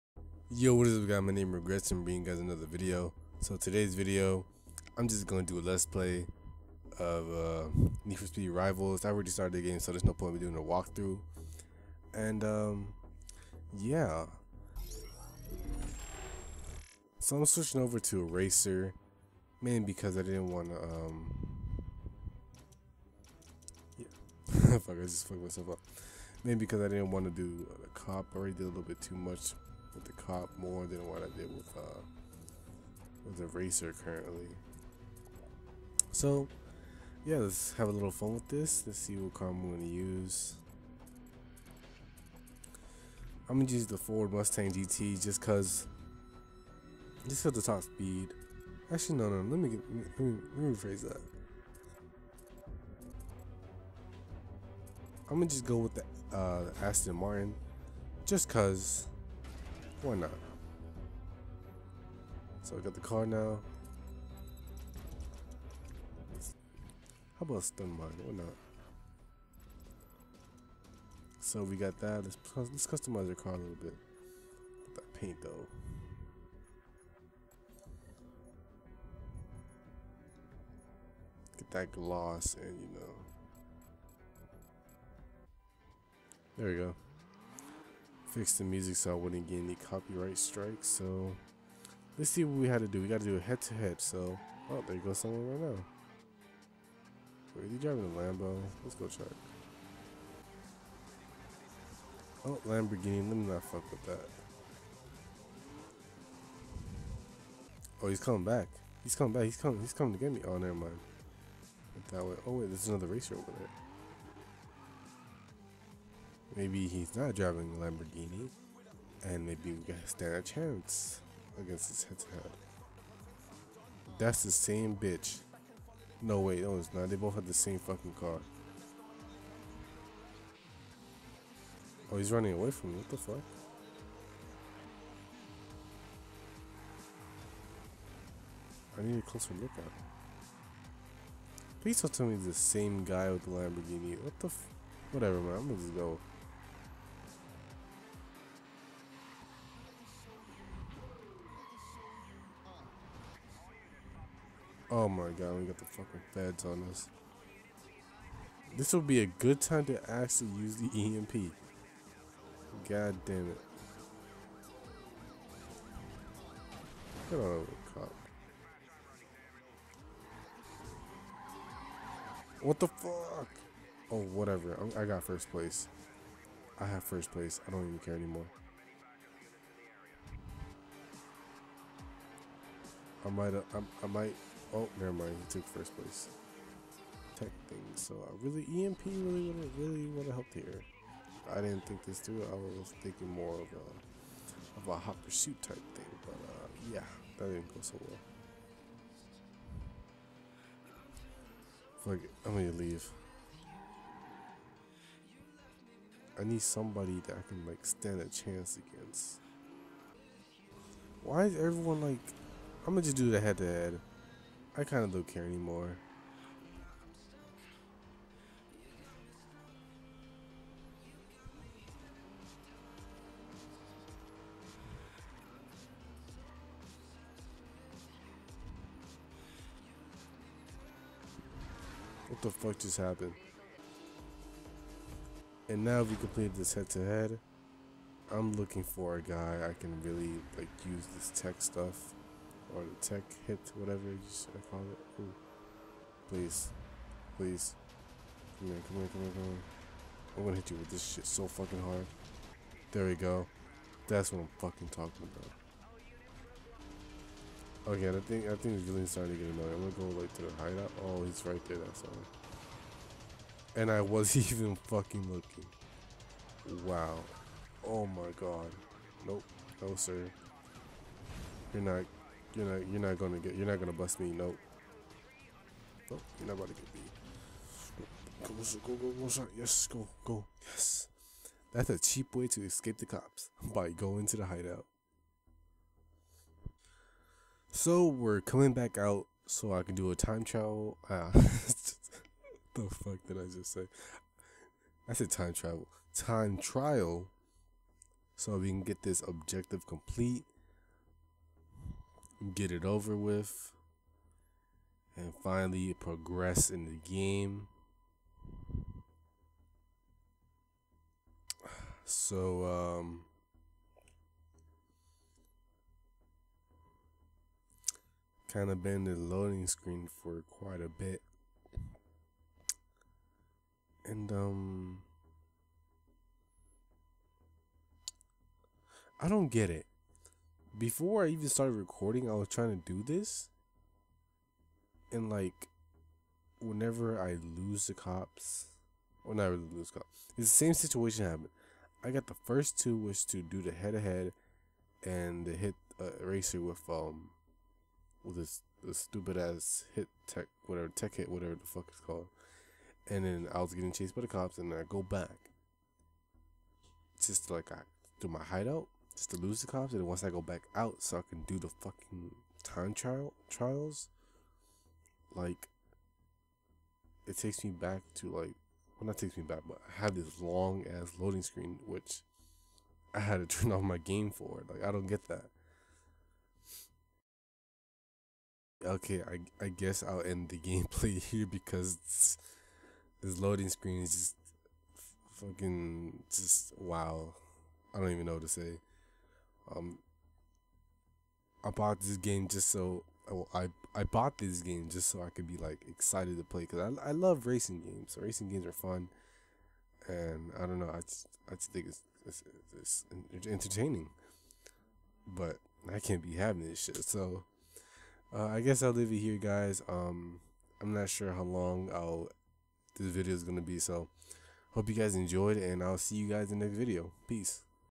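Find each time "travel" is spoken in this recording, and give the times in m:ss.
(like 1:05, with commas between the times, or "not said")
4:50, 4:55.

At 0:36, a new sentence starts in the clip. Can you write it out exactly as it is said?
So, yeah, let's have a little fun with this.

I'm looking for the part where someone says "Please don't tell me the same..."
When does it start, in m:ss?
2:21.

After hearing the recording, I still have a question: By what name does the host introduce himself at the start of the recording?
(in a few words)
Regrets.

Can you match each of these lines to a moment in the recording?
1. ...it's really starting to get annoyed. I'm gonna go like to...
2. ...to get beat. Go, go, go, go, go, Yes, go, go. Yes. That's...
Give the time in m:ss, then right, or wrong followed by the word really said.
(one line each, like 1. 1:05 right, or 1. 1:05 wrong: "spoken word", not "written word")
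1. 4:18 right
2. 4:36 right.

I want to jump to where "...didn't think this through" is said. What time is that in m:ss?
3:11.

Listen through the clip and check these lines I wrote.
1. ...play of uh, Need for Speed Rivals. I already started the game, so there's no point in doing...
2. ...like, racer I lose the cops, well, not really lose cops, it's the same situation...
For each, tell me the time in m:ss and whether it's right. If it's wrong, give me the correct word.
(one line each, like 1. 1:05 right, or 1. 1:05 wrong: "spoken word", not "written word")
1. 0:05 right
2. 5:35 wrong: "whenever", not "racer".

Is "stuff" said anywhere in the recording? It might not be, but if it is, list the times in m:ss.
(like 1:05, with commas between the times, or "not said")
4:01.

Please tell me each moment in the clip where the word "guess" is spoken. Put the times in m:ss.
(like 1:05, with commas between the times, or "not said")
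6:19, 6:48.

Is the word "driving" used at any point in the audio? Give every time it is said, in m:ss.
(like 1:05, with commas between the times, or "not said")
1:37, 1:57.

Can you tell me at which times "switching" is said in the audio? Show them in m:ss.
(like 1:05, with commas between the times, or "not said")
0:17.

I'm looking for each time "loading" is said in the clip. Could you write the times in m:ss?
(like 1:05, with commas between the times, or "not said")
5:19, 6:11, 6:23.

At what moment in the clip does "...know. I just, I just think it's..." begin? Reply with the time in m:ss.
6:40.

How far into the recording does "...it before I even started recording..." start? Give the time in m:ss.
5:29.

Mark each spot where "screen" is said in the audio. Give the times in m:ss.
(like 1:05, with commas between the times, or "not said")
5:19, 6:11, 6:23.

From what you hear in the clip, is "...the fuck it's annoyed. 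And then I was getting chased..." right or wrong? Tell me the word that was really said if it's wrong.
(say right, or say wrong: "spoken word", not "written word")
wrong: "called", not "annoyed".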